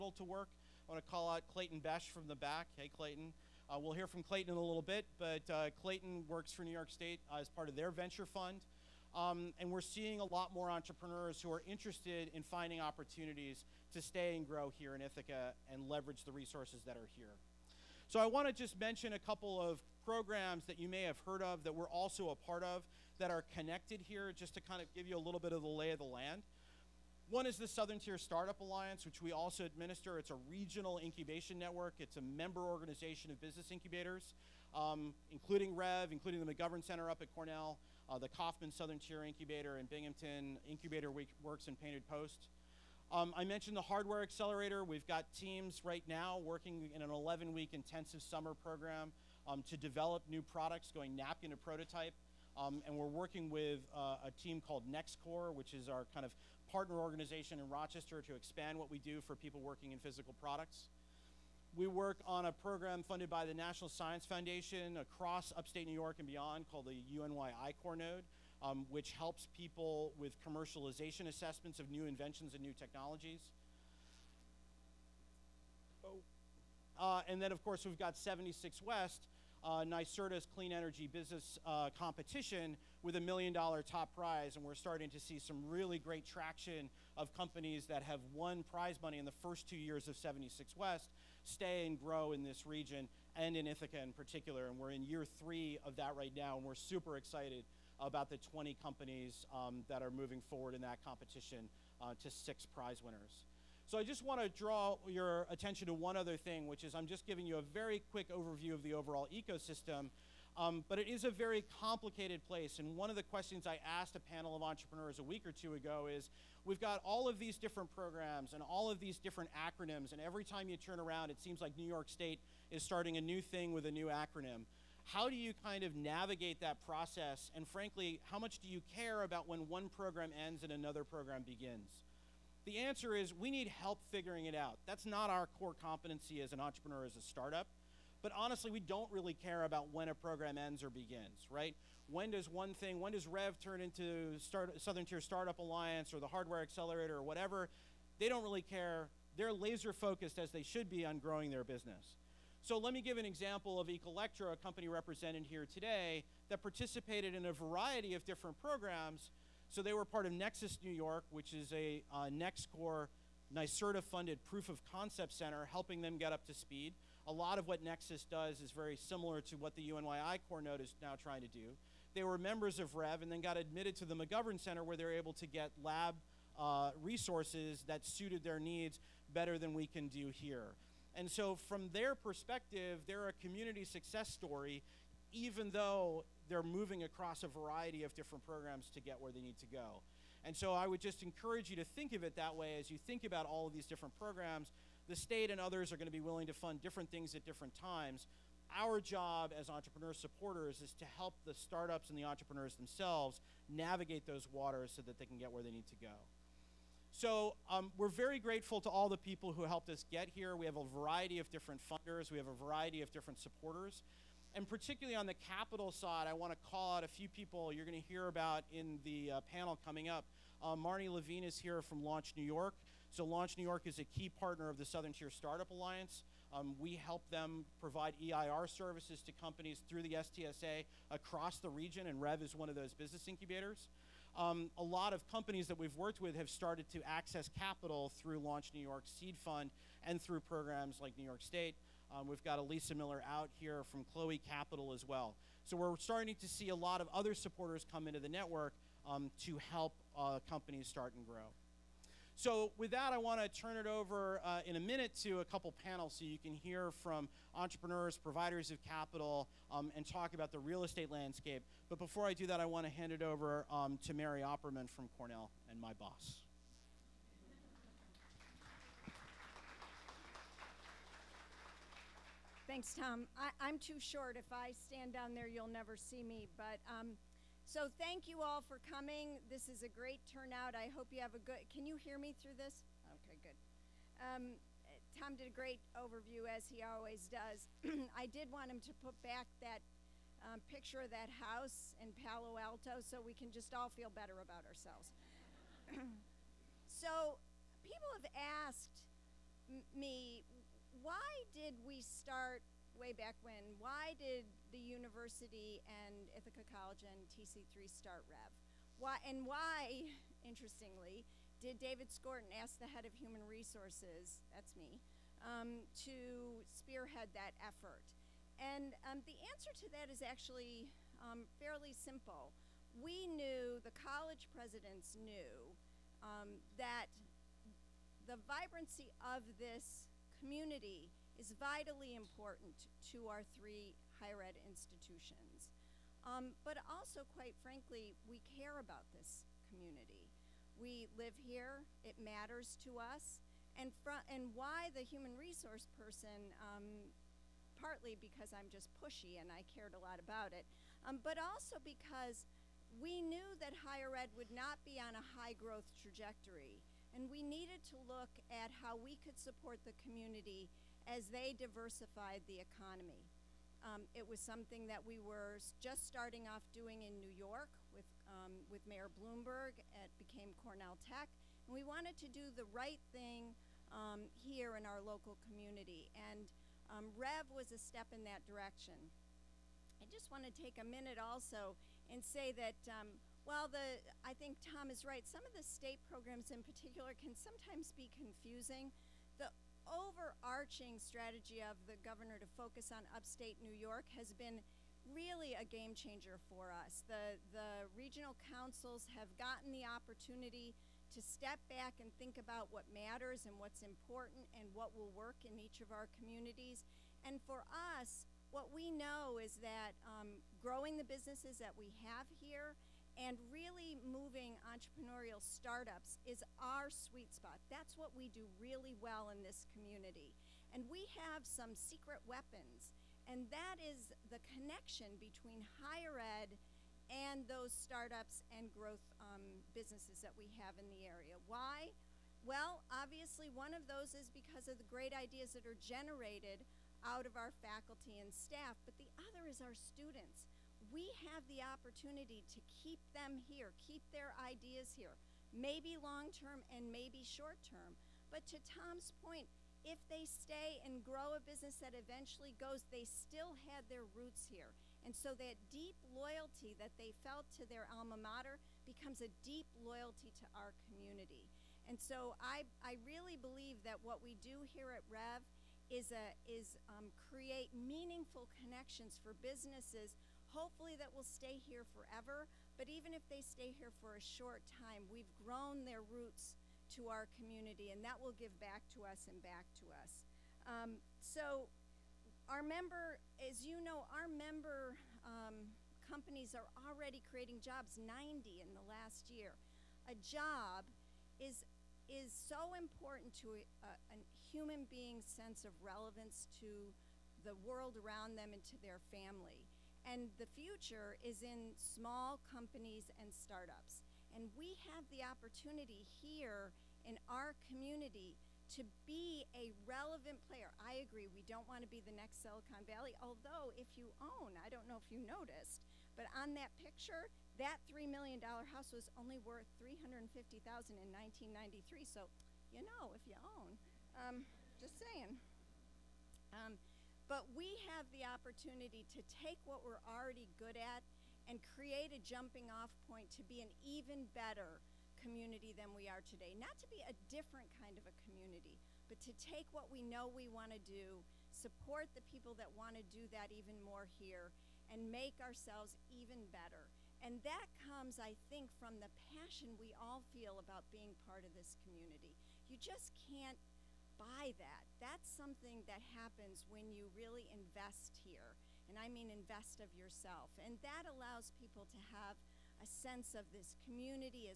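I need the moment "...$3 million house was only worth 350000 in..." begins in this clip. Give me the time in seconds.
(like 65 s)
517 s.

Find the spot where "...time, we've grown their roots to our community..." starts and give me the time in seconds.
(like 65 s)
474 s.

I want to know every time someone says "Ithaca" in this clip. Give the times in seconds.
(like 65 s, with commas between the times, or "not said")
15 s, 93 s, 306 s.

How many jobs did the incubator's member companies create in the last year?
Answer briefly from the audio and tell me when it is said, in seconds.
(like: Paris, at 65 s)
90, at 487 s.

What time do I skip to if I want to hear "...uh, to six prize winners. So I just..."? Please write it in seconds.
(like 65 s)
102 s.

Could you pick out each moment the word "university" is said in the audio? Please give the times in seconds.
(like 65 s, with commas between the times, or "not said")
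304 s.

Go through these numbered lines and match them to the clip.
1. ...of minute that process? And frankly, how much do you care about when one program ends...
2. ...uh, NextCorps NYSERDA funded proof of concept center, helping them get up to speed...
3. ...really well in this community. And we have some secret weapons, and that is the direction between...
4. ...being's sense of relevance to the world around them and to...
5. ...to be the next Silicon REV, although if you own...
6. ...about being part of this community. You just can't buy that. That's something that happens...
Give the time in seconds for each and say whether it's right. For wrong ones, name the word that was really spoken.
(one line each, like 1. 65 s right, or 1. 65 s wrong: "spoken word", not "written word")
1. 125 s wrong: "navigate", not "minute"
2. 162 s right
3. 418 s wrong: "connection", not "direction"
4. 494 s right
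5. 511 s wrong: "Valley", not "REV"
6. 550 s right.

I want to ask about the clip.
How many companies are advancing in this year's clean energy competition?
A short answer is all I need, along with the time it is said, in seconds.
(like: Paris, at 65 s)
20, at 98 s.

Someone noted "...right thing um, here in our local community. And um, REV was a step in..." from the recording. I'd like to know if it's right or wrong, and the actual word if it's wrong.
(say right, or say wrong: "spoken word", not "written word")
right.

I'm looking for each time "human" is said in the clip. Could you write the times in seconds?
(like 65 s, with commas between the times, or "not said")
313 s, 345 s, 494 s.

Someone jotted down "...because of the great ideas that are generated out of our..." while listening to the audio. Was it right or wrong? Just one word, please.
right.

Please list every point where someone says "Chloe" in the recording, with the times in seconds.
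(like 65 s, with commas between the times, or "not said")
244 s.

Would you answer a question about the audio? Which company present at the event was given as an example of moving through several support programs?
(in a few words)
Ecolectro.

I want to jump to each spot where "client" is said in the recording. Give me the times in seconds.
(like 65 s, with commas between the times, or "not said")
not said.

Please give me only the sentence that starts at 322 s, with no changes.
We knew, the college presidents knew, um, that the vibrancy of this community is vitally important to our three higher ed institutions.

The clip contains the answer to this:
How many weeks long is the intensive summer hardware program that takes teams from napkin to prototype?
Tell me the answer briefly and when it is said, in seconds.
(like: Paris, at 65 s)
11, at 47 s.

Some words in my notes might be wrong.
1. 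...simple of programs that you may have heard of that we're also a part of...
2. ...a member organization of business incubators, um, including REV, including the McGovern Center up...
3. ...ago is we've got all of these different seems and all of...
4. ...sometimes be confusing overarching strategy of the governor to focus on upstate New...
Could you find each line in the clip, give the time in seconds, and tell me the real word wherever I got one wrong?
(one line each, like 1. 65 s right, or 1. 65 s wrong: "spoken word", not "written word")
1. 19 s wrong: "couple", not "simple"
2. 32 s right
3. 115 s wrong: "programs", not "seems"
4. 387 s right.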